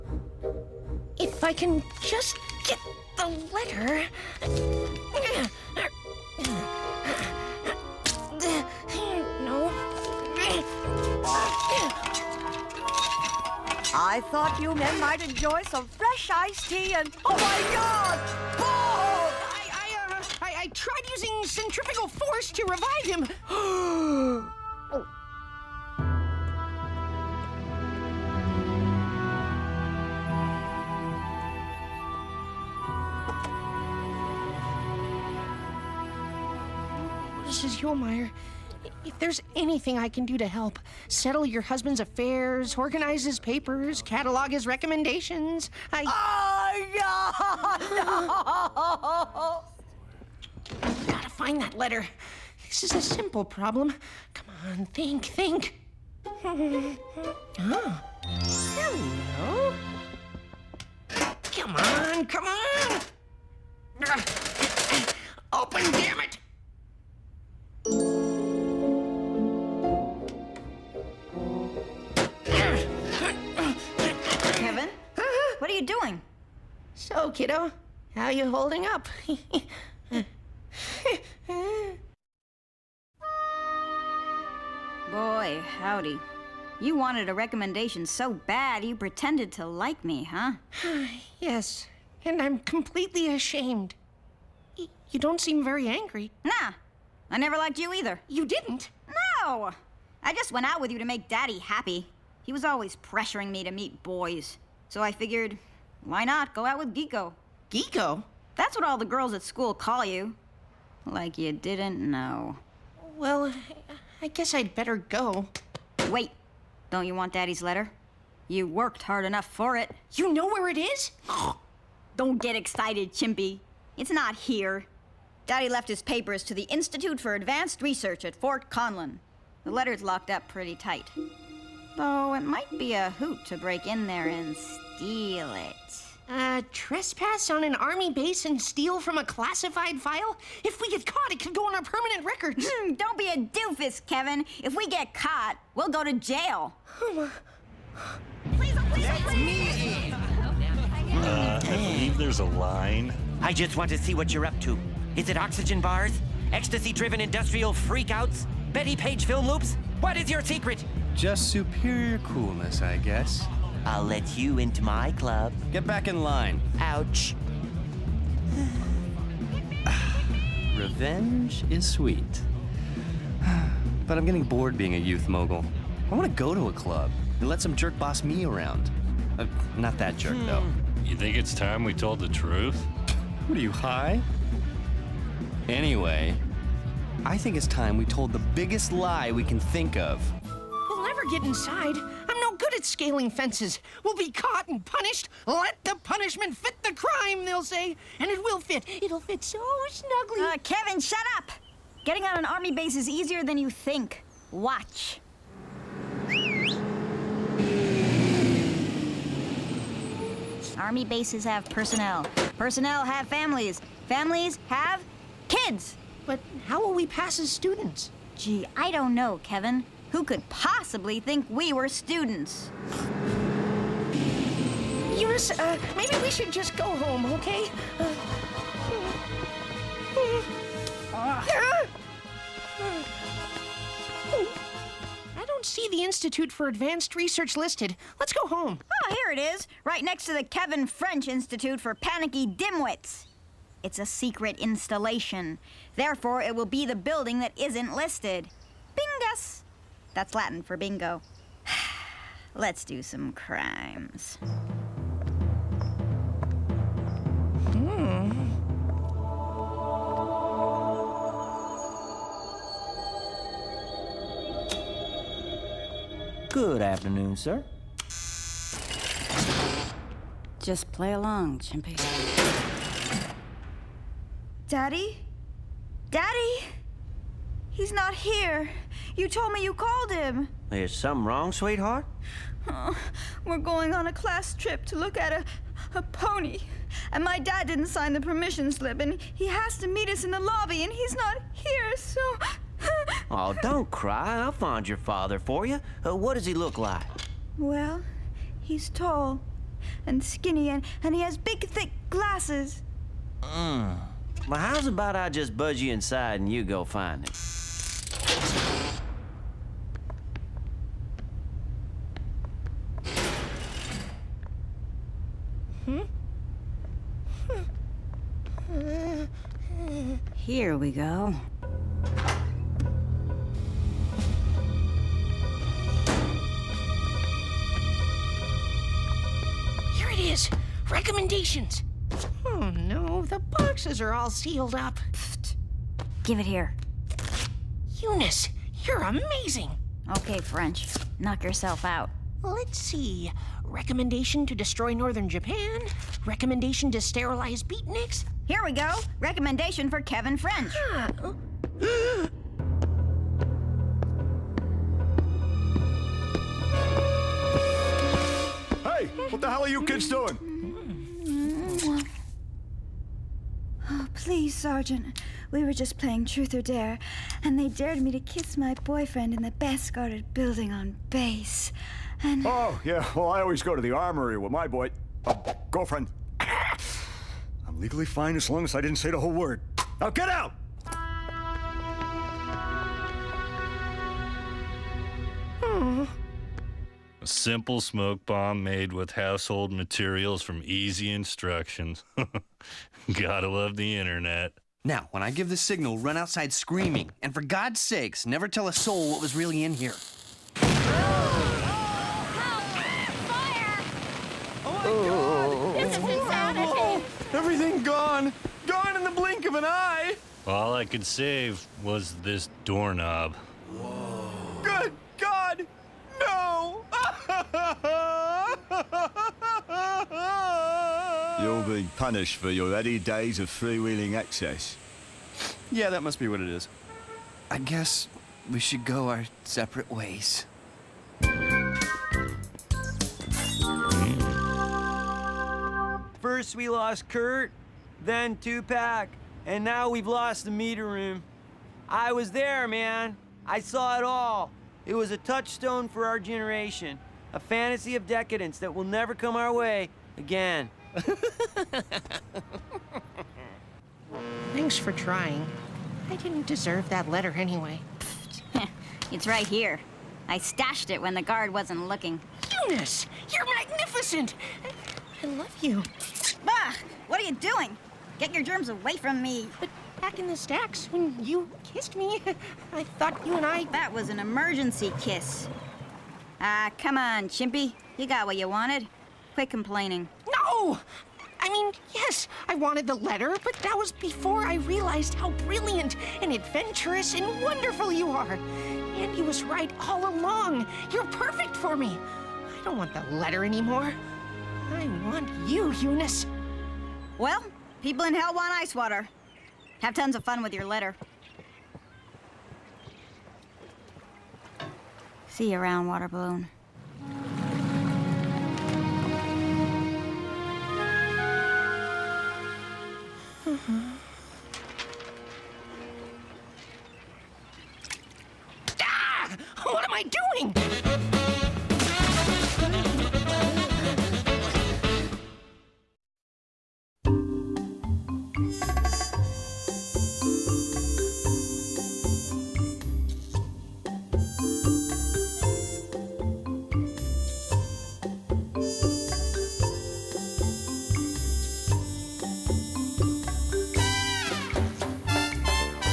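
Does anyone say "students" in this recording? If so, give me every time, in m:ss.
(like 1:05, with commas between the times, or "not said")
3:37, 3:41.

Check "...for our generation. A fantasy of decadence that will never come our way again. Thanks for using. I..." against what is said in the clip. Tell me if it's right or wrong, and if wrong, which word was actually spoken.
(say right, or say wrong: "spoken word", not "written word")
wrong: "trying", not "using".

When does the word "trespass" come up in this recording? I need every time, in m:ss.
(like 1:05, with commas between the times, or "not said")
2:16.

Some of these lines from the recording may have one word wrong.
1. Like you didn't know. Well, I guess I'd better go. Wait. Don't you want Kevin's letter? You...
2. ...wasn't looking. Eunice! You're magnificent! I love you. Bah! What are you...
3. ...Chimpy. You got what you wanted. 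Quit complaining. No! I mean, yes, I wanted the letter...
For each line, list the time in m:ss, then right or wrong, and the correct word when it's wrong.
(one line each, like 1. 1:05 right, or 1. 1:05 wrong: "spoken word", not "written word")
1. 1:51 wrong: "Daddy", not "Kevin"
2. 7:41 right
3. 7:57 right.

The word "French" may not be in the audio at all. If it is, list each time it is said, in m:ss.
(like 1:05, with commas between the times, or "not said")
4:00, 5:40, 5:50.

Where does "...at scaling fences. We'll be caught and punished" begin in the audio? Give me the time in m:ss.
3:12.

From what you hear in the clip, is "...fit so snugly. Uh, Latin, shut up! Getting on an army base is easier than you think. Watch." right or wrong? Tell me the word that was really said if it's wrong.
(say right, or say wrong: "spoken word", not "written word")
wrong: "Kevin", not "Latin".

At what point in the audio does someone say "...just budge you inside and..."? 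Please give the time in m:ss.
5:05.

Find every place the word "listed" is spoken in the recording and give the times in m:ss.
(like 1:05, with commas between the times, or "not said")
3:57, 4:07.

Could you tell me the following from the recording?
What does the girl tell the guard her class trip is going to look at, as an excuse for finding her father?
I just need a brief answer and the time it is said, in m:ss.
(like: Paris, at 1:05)
A pony, at 4:46.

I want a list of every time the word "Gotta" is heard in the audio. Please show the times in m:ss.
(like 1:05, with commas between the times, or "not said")
0:51, 6:33.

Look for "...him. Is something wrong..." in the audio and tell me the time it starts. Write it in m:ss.
4:40.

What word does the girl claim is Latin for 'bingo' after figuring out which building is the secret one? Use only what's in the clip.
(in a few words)
Bingus.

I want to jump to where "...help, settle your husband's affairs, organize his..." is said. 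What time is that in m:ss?
0:40.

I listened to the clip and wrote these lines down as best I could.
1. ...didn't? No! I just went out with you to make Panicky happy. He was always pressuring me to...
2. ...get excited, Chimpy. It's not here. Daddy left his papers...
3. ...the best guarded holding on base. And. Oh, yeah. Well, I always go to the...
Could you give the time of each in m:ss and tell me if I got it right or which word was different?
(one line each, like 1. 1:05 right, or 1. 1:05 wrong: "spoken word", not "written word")
1. 1:38 wrong: "Daddy", not "Panicky"
2. 2:02 right
3. 6:09 wrong: "building", not "holding".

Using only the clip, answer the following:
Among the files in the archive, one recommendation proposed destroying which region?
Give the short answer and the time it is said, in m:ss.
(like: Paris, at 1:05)
Northern Japan, at 5:44.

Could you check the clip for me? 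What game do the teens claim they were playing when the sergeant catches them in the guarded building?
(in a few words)
Truth or dare.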